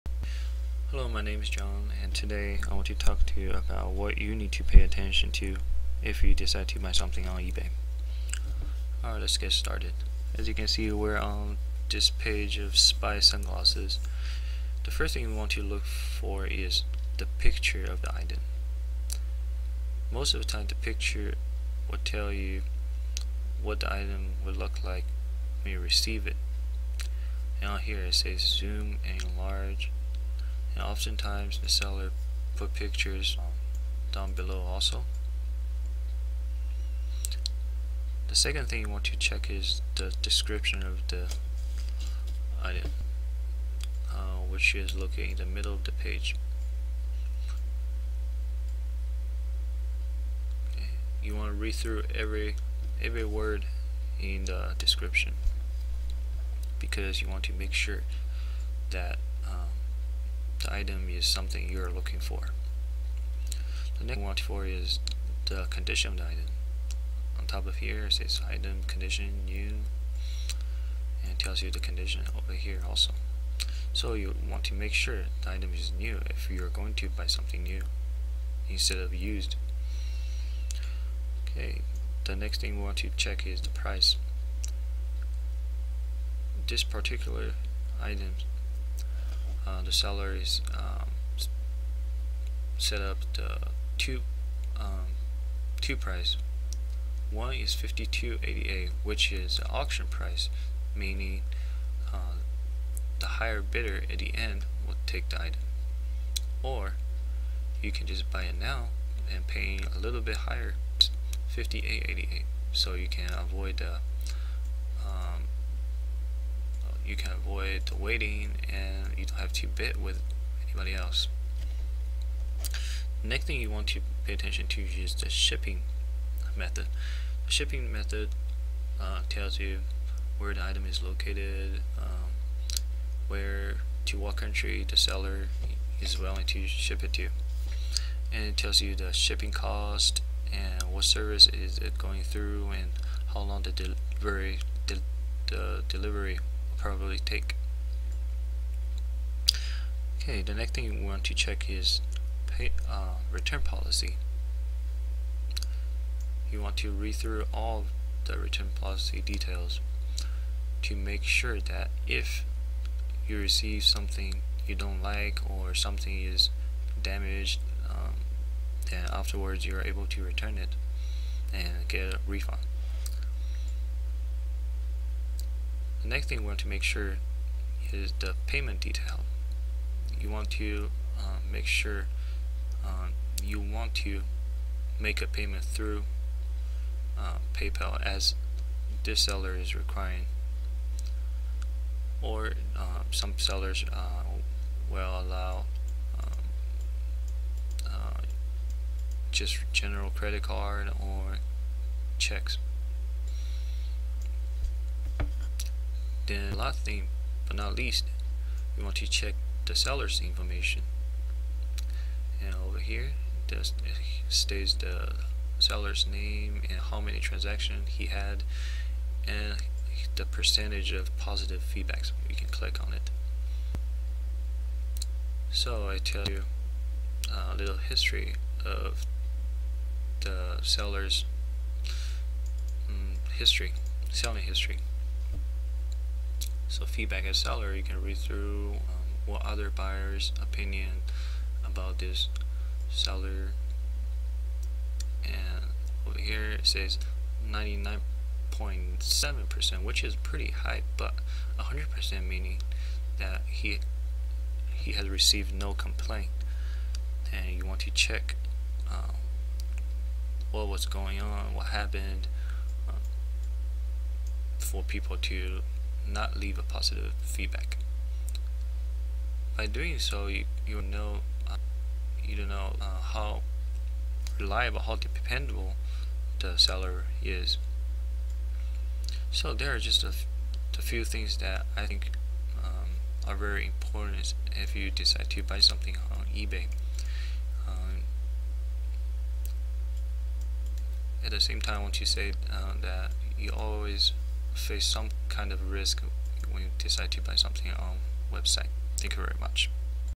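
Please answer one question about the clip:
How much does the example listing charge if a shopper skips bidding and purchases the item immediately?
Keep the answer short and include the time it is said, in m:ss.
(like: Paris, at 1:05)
58.88, at 1:51.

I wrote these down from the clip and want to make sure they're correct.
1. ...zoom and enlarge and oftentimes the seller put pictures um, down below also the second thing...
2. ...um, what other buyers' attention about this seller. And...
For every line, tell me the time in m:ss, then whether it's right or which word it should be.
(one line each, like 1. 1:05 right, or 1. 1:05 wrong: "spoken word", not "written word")
1. 0:28 right
2. 3:58 wrong: "opinion", not "attention".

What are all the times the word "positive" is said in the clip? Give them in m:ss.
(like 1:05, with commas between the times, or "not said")
3:41, 4:26.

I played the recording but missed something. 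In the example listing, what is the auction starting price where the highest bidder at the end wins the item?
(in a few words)
52.88.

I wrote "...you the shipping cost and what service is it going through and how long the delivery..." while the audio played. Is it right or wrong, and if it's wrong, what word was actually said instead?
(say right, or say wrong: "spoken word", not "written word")
right.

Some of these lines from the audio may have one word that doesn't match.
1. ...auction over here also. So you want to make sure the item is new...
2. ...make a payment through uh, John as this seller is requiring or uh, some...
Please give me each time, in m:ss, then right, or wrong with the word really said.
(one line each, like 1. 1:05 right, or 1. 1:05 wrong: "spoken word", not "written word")
1. 1:11 wrong: "condition", not "auction"
2. 3:04 wrong: "PayPal", not "John".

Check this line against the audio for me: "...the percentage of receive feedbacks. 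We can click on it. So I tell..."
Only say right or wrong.
wrong.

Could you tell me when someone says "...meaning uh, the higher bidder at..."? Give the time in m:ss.
1:40.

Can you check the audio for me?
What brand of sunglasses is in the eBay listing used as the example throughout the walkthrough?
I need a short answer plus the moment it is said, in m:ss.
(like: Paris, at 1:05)
Spy, at 0:12.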